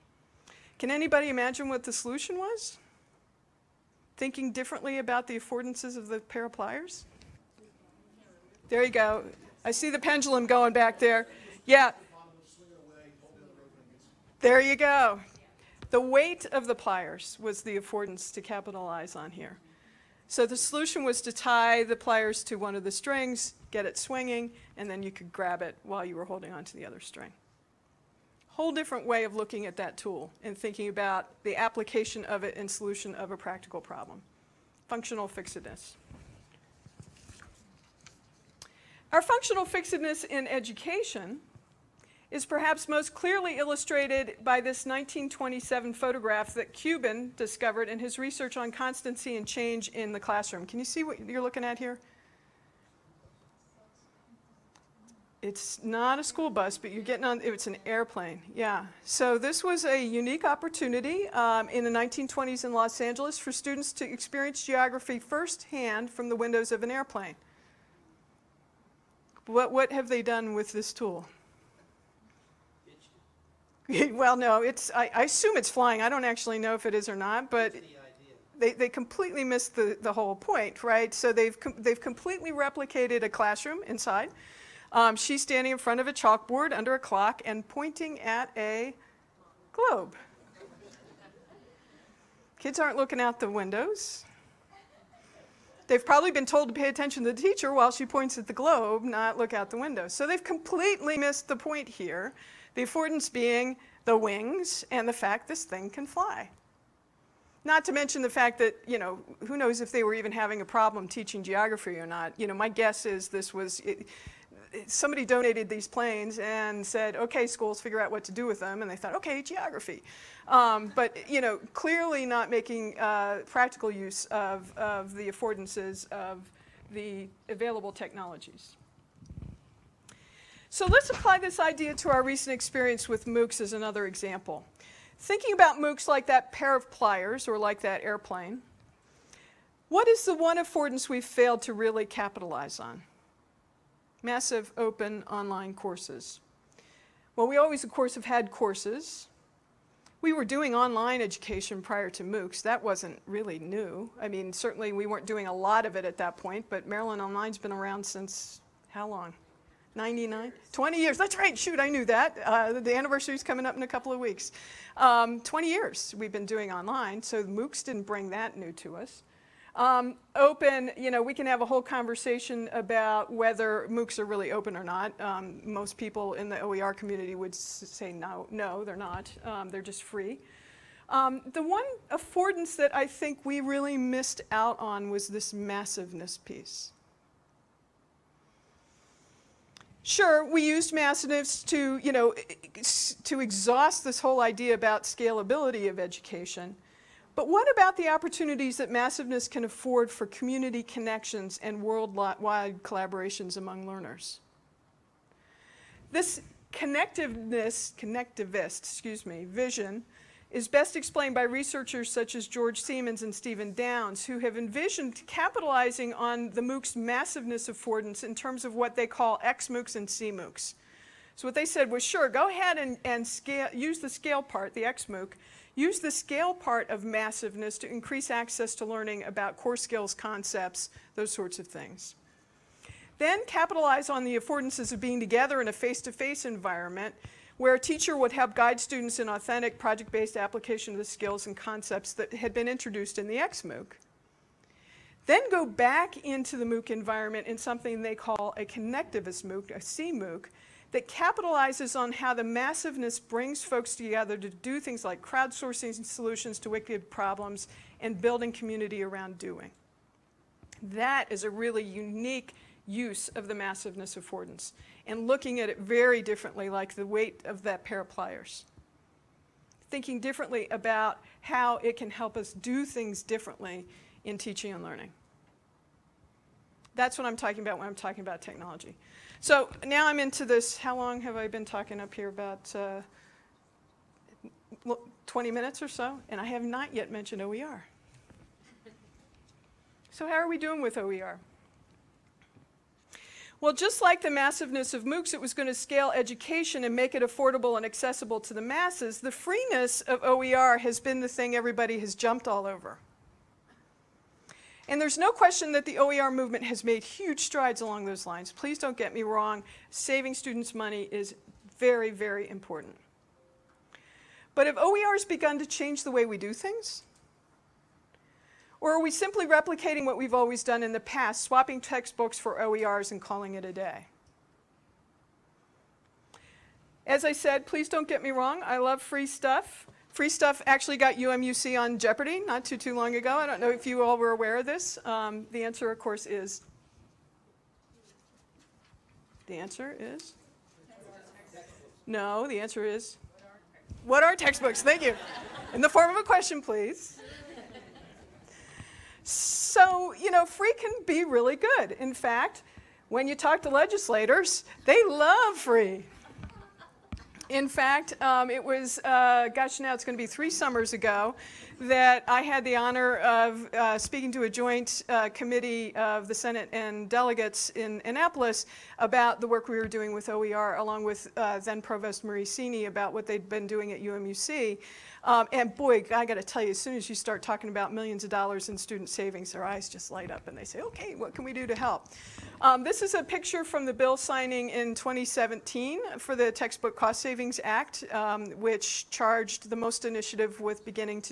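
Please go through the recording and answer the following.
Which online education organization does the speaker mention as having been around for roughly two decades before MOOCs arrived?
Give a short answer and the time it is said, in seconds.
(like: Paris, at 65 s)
Maryland Online, at 156 s.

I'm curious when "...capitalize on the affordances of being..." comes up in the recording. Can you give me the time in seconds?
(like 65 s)
233 s.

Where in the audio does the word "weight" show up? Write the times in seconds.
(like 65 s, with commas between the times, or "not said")
16 s, 267 s.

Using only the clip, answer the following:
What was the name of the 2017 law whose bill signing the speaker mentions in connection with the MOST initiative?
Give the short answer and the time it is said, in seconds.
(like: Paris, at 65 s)
Textbook Cost Savings Act, at 386 s.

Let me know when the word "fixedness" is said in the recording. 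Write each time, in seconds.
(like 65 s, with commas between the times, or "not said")
35 s, 39 s.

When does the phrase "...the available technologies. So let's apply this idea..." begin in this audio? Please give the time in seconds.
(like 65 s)
126 s.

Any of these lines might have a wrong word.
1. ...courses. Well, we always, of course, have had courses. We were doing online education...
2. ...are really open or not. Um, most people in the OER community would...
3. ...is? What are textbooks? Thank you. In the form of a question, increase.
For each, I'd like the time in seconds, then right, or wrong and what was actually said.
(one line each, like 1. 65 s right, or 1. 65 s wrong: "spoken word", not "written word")
1. 145 s right
2. 174 s right
3. 342 s wrong: "please", not "increase".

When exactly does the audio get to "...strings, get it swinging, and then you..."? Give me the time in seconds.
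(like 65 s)
22 s.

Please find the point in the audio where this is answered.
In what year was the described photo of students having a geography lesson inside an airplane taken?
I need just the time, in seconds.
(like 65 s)
44 s.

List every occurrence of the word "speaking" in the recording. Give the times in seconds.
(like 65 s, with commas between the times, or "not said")
363 s.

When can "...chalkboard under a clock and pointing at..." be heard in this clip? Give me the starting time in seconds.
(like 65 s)
86 s.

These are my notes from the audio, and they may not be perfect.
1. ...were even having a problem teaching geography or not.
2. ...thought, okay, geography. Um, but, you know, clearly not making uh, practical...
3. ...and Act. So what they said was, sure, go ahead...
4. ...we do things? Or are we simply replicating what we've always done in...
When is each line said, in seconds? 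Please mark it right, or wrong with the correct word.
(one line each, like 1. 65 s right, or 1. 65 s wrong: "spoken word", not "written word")
1. 110 s right
2. 118 s right
3. 219 s wrong: "CMOOCs", not "Act"
4. 316 s right.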